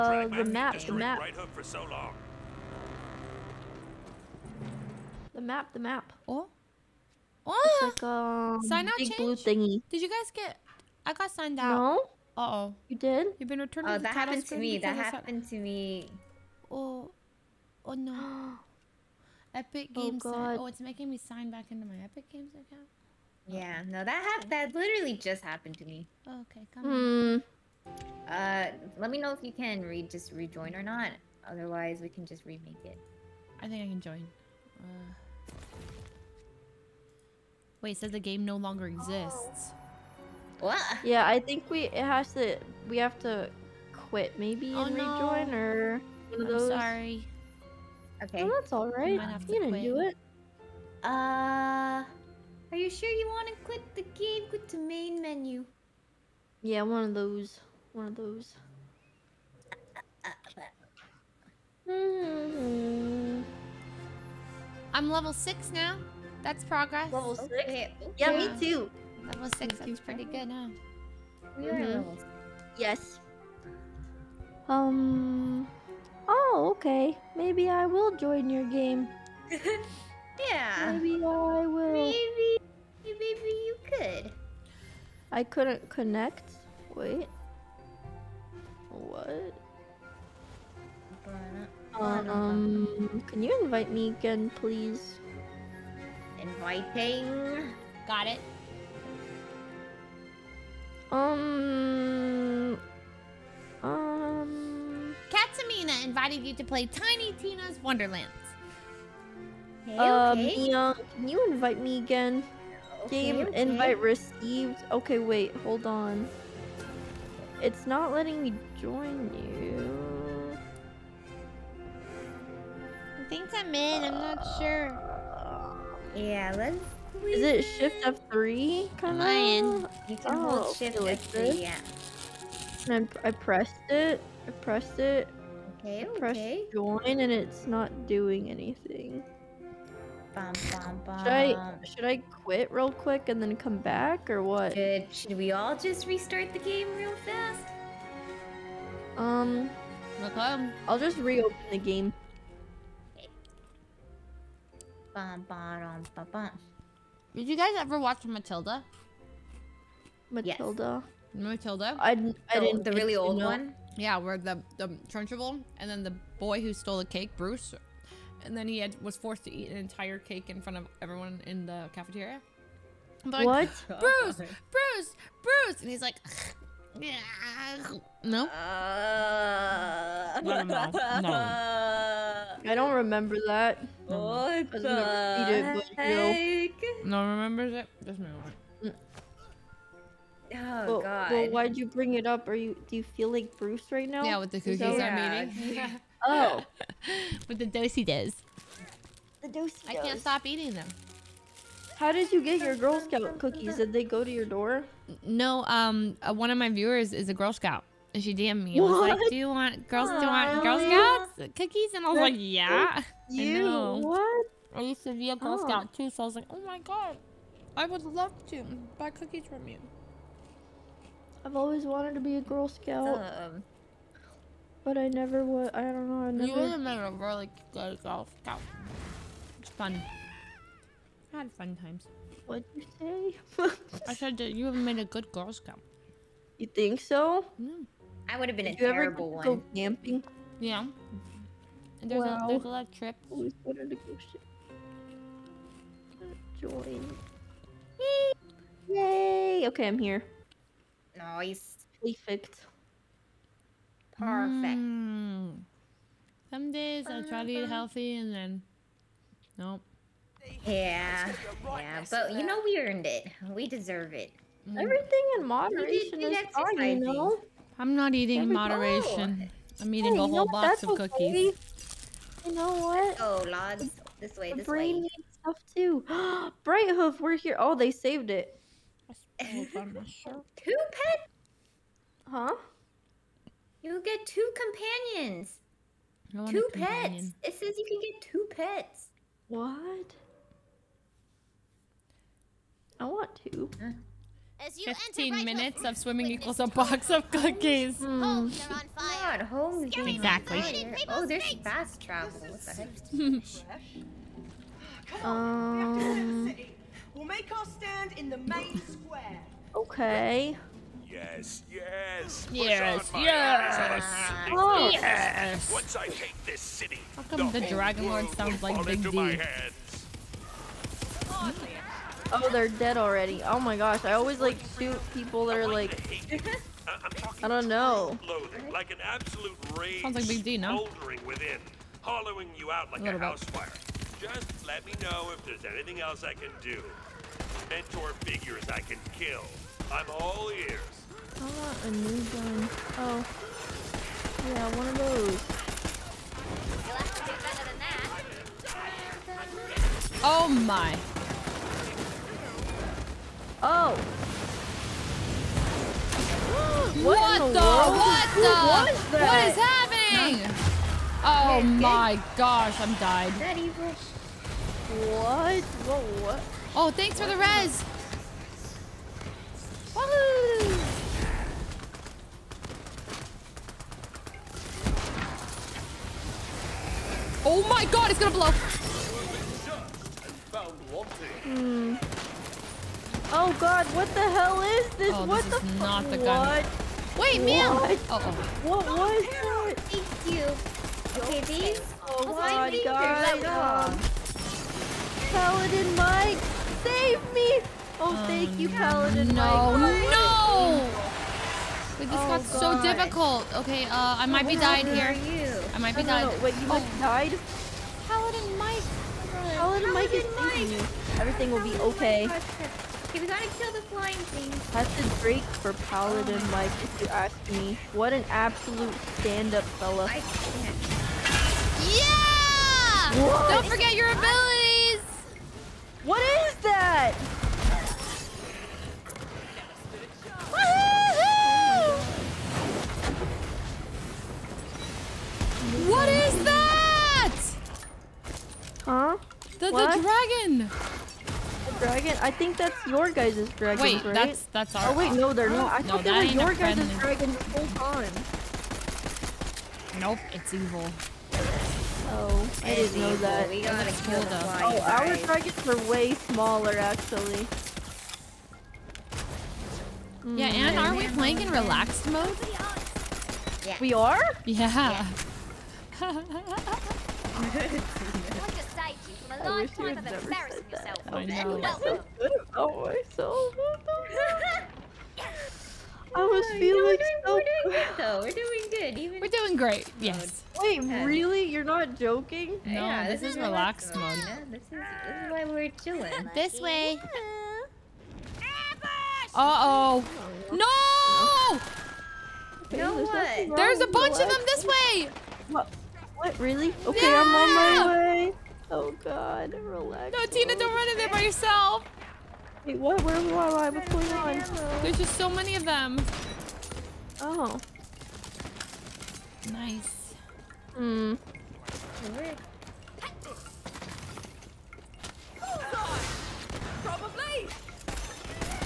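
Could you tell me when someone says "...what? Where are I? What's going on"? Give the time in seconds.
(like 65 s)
502 s.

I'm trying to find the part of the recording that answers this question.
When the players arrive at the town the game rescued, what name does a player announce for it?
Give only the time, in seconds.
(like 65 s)
276 s.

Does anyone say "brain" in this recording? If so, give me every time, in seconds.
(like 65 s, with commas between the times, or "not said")
274 s.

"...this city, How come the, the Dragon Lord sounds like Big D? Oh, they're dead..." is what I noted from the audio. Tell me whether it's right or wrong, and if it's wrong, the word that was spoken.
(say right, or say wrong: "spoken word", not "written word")
right.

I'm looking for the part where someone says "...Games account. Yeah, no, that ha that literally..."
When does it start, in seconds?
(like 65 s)
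22 s.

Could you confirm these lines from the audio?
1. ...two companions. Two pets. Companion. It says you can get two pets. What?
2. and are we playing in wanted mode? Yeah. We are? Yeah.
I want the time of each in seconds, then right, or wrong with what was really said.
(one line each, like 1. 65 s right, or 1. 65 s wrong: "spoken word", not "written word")
1. 284 s right
2. 460 s wrong: "relaxed", not "wanted".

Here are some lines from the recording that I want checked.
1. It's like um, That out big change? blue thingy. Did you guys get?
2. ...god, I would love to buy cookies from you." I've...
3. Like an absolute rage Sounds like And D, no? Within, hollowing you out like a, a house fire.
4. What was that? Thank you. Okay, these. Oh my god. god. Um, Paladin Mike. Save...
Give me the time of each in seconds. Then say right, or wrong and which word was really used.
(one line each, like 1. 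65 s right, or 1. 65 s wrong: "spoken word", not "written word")
1. 7 s wrong: "Sign", not "That"
2. 216 s right
3. 328 s wrong: "Big", not "And"
4. 388 s right.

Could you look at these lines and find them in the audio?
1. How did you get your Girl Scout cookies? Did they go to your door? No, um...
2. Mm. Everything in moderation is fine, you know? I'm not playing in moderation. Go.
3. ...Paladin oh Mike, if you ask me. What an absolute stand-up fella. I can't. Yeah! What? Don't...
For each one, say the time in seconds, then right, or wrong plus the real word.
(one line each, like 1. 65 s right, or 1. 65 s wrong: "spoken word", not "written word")
1. 201 s right
2. 264 s wrong: "eating", not "playing"
3. 415 s right.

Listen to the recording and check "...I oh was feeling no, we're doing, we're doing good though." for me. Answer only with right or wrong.
right.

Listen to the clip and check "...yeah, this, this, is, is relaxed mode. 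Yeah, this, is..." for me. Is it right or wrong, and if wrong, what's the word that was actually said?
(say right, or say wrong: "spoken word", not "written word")
right.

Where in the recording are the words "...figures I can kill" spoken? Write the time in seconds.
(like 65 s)
338 s.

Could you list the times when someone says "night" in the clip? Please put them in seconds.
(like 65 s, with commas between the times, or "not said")
not said.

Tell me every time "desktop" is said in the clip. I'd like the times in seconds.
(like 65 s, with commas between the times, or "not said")
not said.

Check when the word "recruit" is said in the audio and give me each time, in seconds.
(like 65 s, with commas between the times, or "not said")
not said.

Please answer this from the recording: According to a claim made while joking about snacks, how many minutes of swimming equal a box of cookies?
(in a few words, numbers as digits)
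15.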